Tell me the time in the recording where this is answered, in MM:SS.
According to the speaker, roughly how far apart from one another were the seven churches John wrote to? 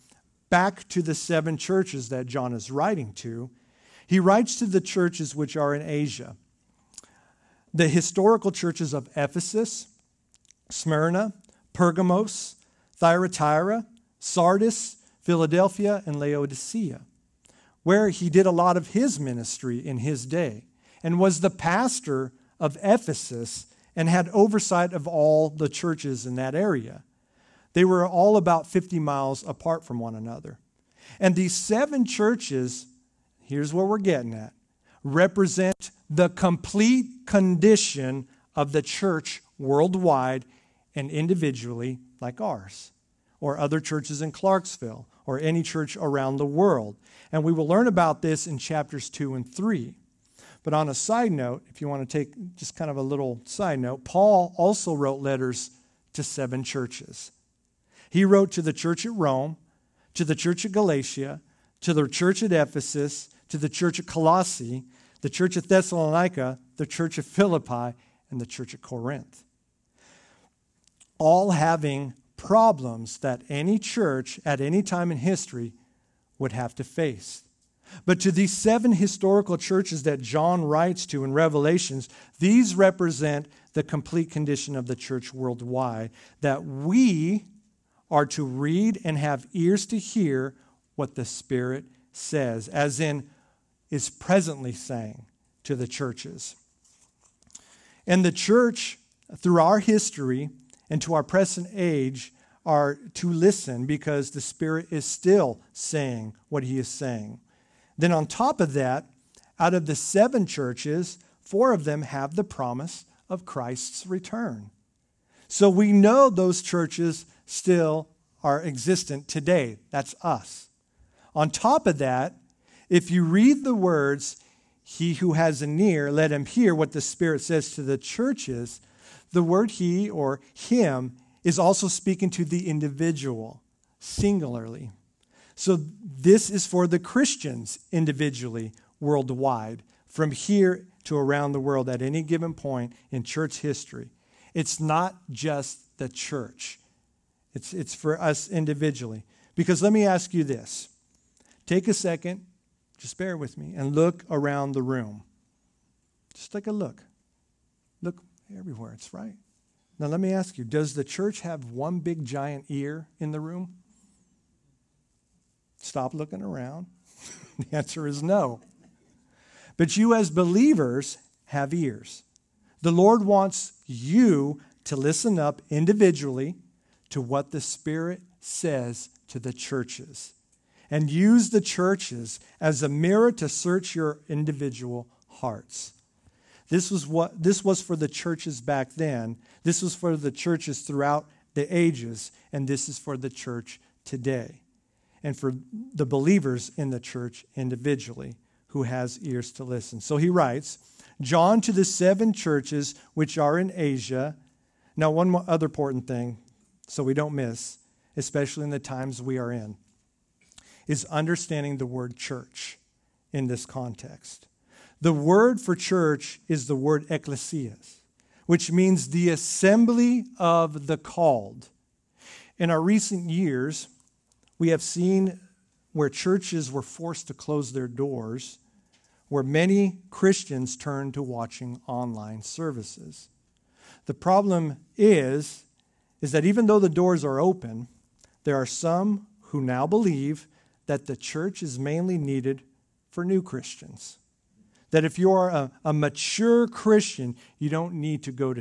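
00:28.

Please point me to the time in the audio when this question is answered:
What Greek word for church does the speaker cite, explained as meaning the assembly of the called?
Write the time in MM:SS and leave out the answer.
03:37.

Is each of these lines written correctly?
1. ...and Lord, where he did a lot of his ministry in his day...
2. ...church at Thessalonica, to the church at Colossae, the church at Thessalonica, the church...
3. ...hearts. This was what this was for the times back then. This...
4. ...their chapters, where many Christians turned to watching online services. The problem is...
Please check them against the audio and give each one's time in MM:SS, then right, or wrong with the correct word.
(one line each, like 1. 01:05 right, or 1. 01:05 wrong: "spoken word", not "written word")
1. 00:16 wrong: "Laodicea", not "Lord"
2. 01:02 wrong: "Ephesus", not "Thessalonica"
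3. 03:05 wrong: "churches", not "times"
4. 03:47 wrong: "doors", not "chapters".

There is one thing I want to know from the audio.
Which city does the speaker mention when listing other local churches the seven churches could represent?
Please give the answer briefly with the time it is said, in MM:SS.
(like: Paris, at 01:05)
Clarksville, at 00:44.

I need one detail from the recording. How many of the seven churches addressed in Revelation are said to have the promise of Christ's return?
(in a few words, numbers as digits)
4.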